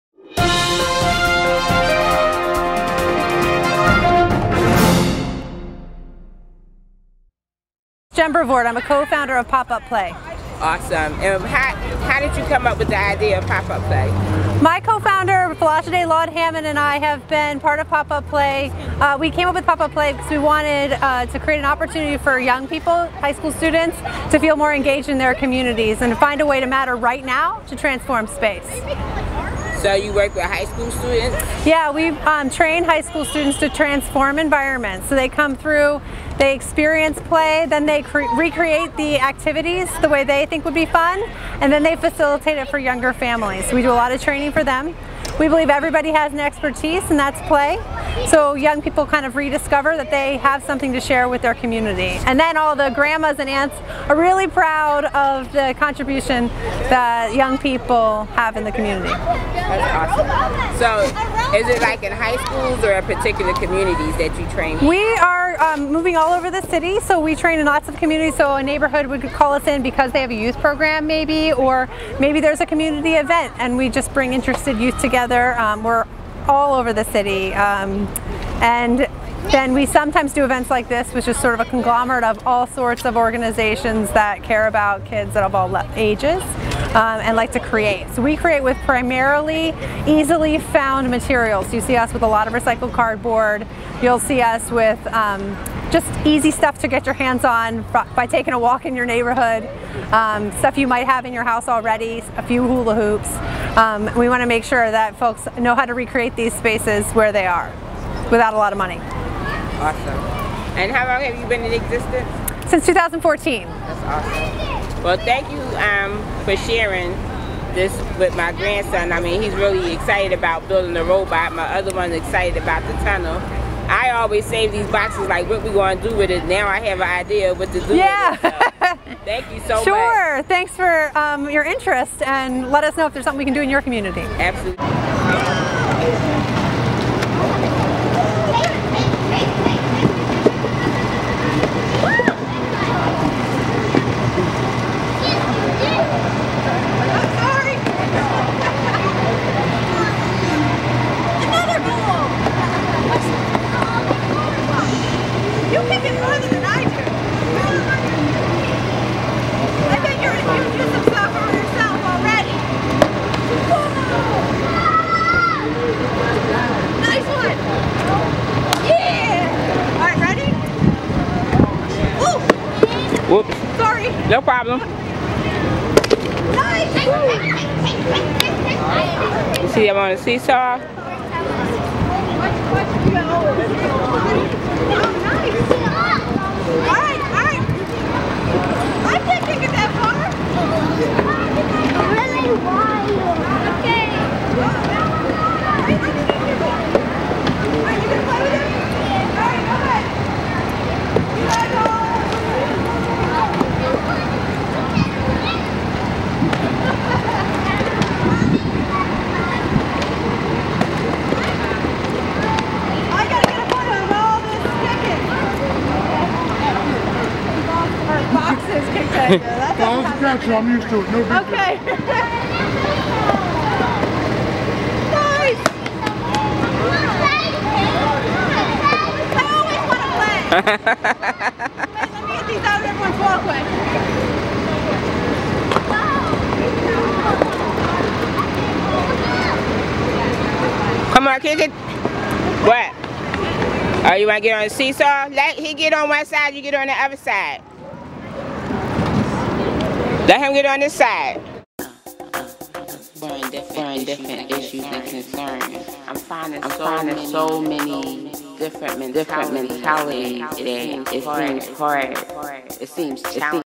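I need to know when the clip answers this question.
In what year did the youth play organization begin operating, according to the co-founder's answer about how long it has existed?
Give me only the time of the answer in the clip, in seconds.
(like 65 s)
112 s.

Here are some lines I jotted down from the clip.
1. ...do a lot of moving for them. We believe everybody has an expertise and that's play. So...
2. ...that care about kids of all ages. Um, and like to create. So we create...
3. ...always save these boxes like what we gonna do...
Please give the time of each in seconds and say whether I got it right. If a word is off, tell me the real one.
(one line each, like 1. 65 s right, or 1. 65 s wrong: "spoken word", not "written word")
1. 43 s wrong: "training", not "moving"
2. 84 s right
3. 124 s right.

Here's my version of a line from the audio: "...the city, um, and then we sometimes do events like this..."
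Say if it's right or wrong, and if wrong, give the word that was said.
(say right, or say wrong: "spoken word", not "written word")
right.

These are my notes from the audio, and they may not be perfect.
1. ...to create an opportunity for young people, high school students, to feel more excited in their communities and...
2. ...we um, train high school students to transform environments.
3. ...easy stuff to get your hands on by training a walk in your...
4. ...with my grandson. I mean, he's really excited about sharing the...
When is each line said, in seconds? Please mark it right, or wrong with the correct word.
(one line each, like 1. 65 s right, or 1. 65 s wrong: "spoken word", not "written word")
1. 21 s wrong: "engaged", not "excited"
2. 31 s right
3. 96 s wrong: "taking", not "training"
4. 118 s wrong: "building", not "sharing".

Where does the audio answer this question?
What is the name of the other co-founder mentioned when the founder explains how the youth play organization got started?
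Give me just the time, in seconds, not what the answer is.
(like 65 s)
15 s.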